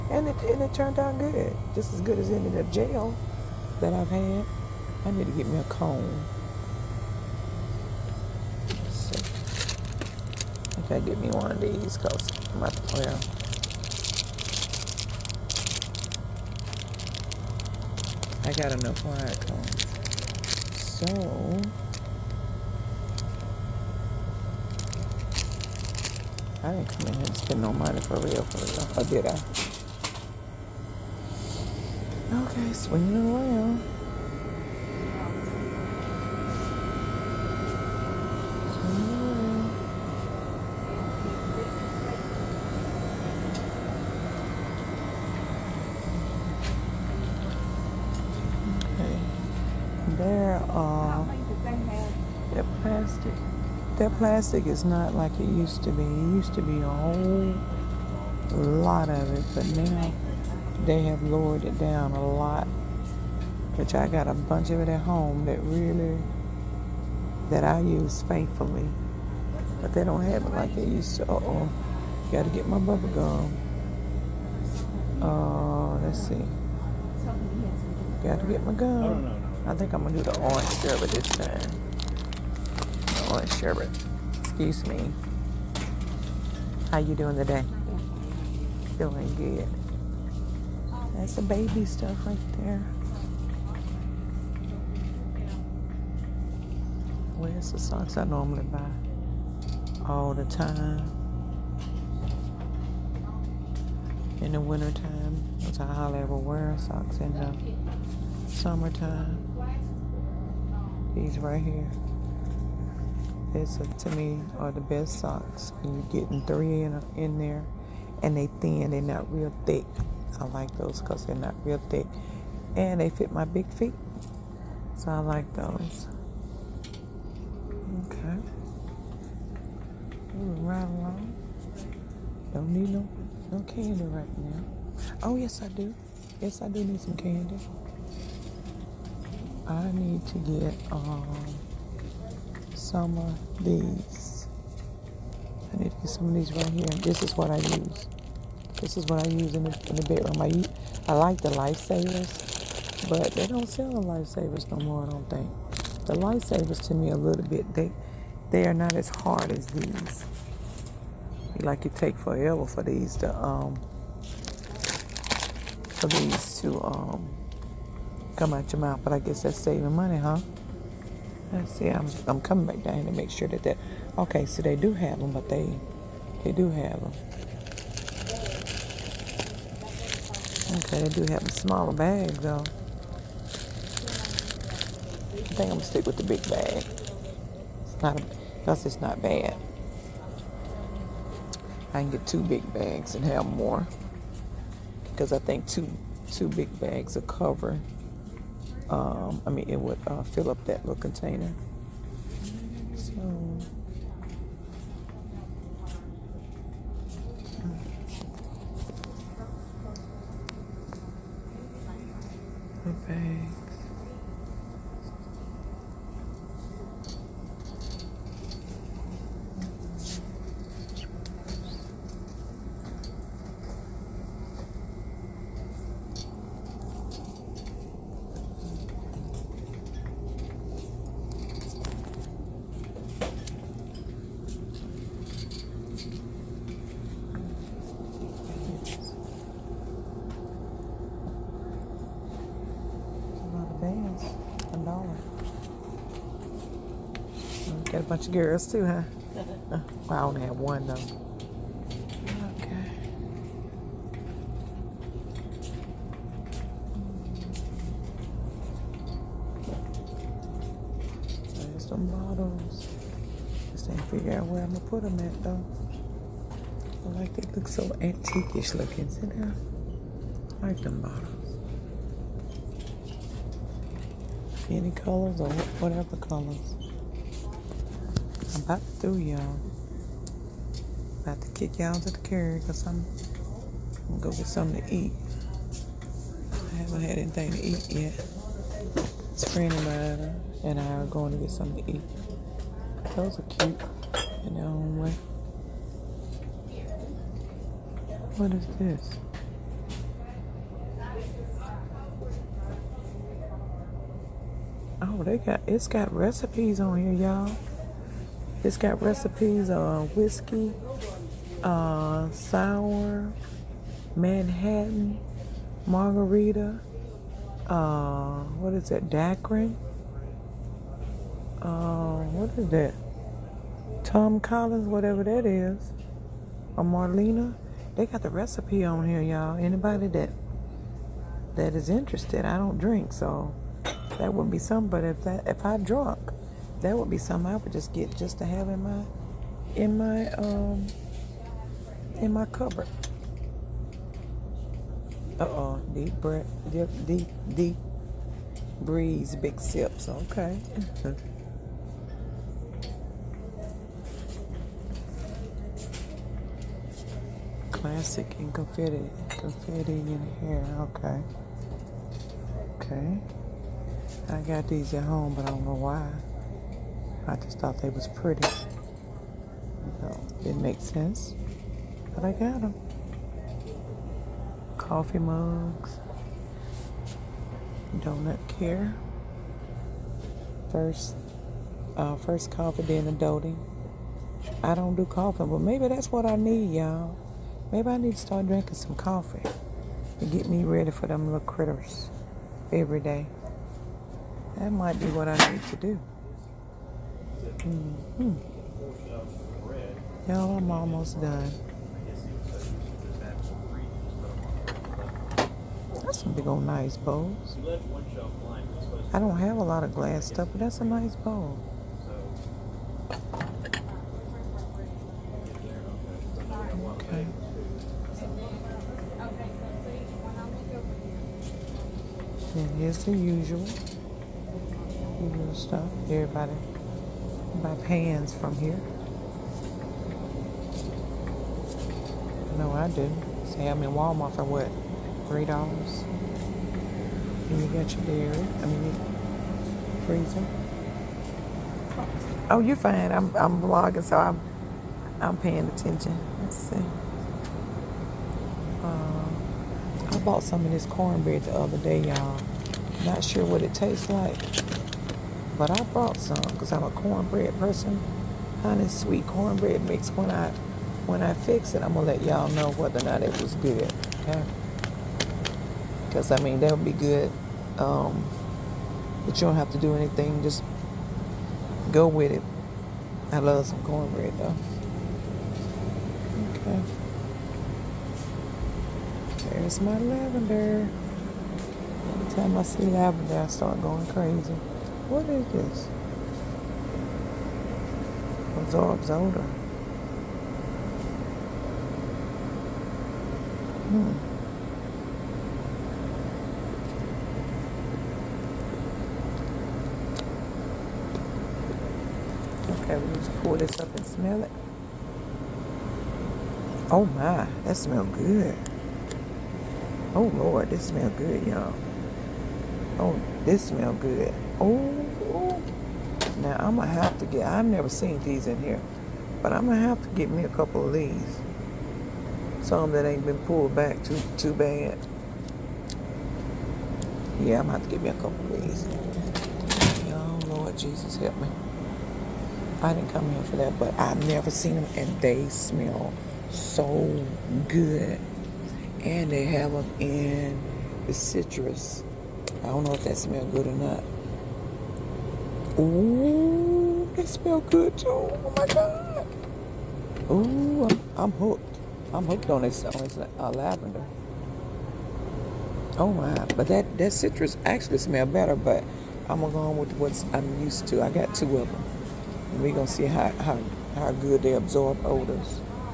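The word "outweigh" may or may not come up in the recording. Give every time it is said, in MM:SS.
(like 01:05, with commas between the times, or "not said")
not said.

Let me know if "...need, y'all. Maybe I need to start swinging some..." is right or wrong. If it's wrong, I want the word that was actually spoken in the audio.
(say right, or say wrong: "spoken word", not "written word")
wrong: "drinking", not "swinging".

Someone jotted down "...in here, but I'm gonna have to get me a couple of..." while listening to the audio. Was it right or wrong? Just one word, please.
right.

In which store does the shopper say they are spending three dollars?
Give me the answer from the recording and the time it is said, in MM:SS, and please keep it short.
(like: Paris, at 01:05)
Walmart, at 07:13.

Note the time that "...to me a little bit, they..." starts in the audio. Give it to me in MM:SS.
02:36.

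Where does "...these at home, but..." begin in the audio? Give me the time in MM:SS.
06:04.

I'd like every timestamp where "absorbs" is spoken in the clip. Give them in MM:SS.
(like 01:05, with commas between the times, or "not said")
08:08, 09:24.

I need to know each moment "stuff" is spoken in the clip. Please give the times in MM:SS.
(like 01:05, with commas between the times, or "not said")
01:31, 06:50, 07:05.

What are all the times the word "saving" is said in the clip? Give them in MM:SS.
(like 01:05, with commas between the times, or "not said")
02:49.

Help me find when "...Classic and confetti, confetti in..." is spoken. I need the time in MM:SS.
05:57.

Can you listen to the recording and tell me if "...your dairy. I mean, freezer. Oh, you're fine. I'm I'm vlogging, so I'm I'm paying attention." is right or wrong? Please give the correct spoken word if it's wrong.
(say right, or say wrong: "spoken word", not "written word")
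right.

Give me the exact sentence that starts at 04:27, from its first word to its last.
I like they look so antiquish looking.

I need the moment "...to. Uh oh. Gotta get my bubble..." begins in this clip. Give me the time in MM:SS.
01:11.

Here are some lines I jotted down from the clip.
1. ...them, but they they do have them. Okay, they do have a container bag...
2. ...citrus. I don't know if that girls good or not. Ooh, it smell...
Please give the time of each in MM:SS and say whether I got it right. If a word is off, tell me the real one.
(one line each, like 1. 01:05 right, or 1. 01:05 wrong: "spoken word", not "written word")
1. 02:55 wrong: "smaller", not "container"
2. 09:01 wrong: "smells", not "girls".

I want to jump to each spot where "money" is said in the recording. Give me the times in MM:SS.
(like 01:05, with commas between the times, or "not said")
00:27, 02:49.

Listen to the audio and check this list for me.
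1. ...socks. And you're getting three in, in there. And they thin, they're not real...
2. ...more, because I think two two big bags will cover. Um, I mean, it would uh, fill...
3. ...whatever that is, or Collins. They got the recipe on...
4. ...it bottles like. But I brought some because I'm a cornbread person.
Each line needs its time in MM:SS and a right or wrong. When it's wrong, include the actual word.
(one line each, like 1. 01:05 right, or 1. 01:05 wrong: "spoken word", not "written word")
1. 01:55 right
2. 03:13 right
3. 05:24 wrong: "Marlena", not "Collins"
4. 07:33 wrong: "tastes", not "bottles".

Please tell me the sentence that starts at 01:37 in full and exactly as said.
Where's the socks I normally buy all the time?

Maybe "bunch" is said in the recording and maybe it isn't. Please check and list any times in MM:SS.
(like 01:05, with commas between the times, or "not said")
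01:04, 04:08.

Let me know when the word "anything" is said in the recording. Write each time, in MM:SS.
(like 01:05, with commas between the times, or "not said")
04:47, 07:49.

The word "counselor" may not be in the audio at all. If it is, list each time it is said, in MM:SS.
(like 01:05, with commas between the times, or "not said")
not said.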